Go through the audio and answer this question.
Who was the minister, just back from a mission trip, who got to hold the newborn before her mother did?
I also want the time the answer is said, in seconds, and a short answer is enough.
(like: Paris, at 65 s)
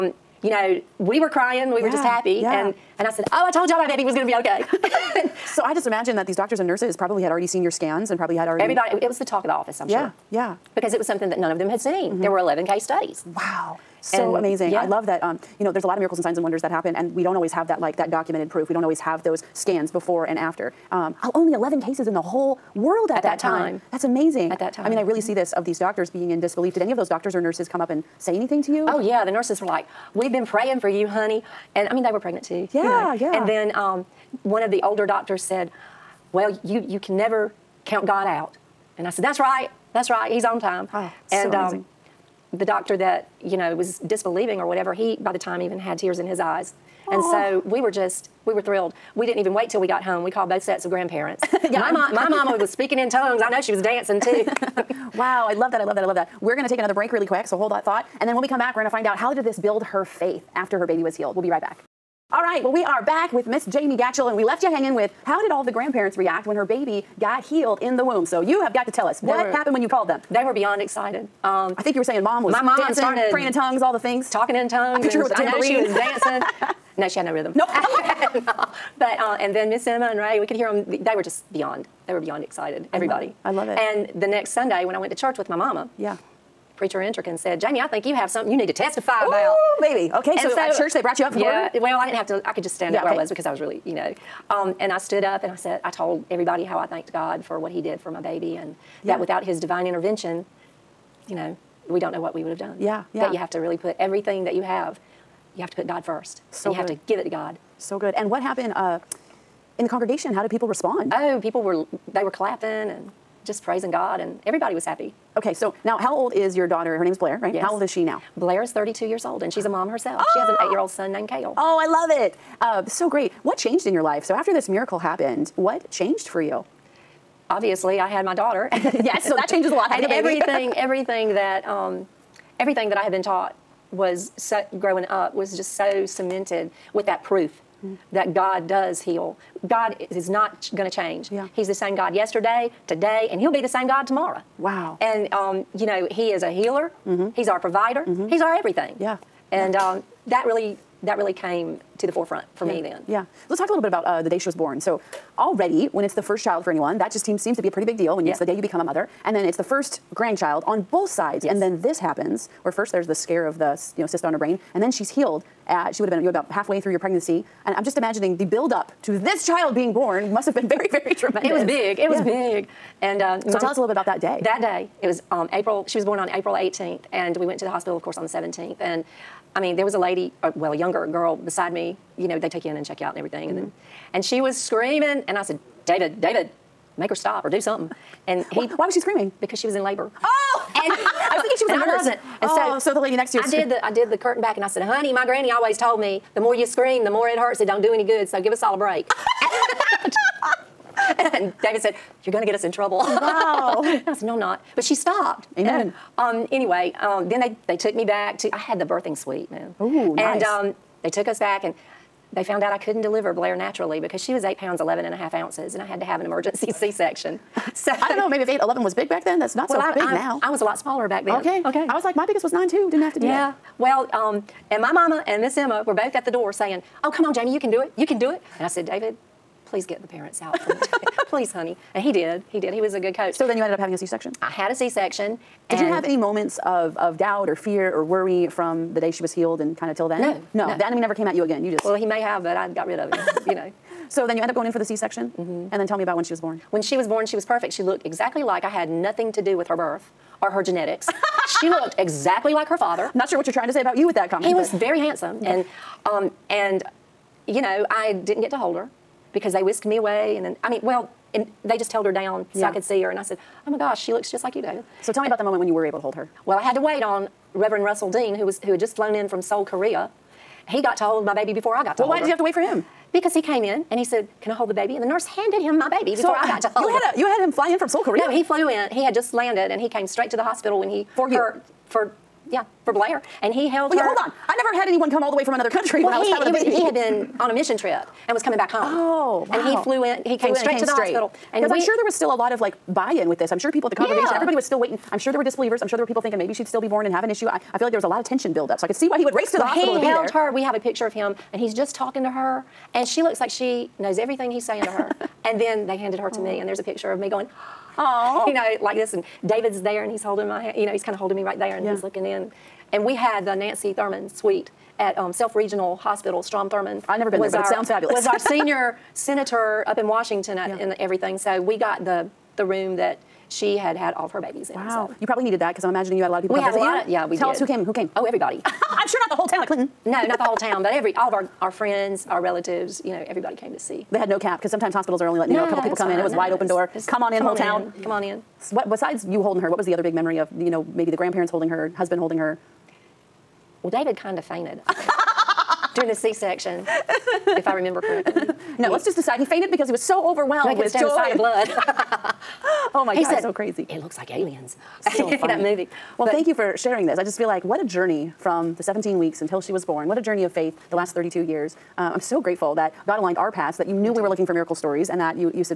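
Reverend Russell Dean, at 267 s.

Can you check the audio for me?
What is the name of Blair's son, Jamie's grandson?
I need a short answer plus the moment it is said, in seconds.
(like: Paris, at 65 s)
Kale, at 121 s.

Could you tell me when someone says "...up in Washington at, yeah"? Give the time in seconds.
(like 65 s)
319 s.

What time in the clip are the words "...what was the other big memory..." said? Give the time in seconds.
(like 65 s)
339 s.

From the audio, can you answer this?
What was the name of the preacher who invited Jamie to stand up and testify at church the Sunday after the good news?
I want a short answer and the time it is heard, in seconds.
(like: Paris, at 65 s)
Enterkin, at 87 s.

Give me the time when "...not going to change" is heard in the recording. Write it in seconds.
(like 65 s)
140 s.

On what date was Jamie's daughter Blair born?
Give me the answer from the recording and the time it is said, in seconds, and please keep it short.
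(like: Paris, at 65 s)
April 18th, at 176 s.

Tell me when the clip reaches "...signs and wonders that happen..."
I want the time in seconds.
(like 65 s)
16 s.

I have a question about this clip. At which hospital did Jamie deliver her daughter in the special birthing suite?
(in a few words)
Self Regional Hospital.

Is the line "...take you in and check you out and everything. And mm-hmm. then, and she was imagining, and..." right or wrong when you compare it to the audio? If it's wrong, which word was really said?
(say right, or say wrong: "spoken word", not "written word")
wrong: "screaming", not "imagining".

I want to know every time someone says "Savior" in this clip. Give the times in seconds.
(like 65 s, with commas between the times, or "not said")
not said.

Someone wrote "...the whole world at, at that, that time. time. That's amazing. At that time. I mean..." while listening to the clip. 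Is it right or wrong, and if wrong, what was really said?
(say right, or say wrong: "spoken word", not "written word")
right.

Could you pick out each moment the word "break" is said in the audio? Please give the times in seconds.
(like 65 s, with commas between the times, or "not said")
56 s, 198 s.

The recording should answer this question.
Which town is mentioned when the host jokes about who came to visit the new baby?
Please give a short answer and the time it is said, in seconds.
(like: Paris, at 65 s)
Clinton, at 329 s.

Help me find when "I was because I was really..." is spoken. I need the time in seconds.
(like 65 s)
93 s.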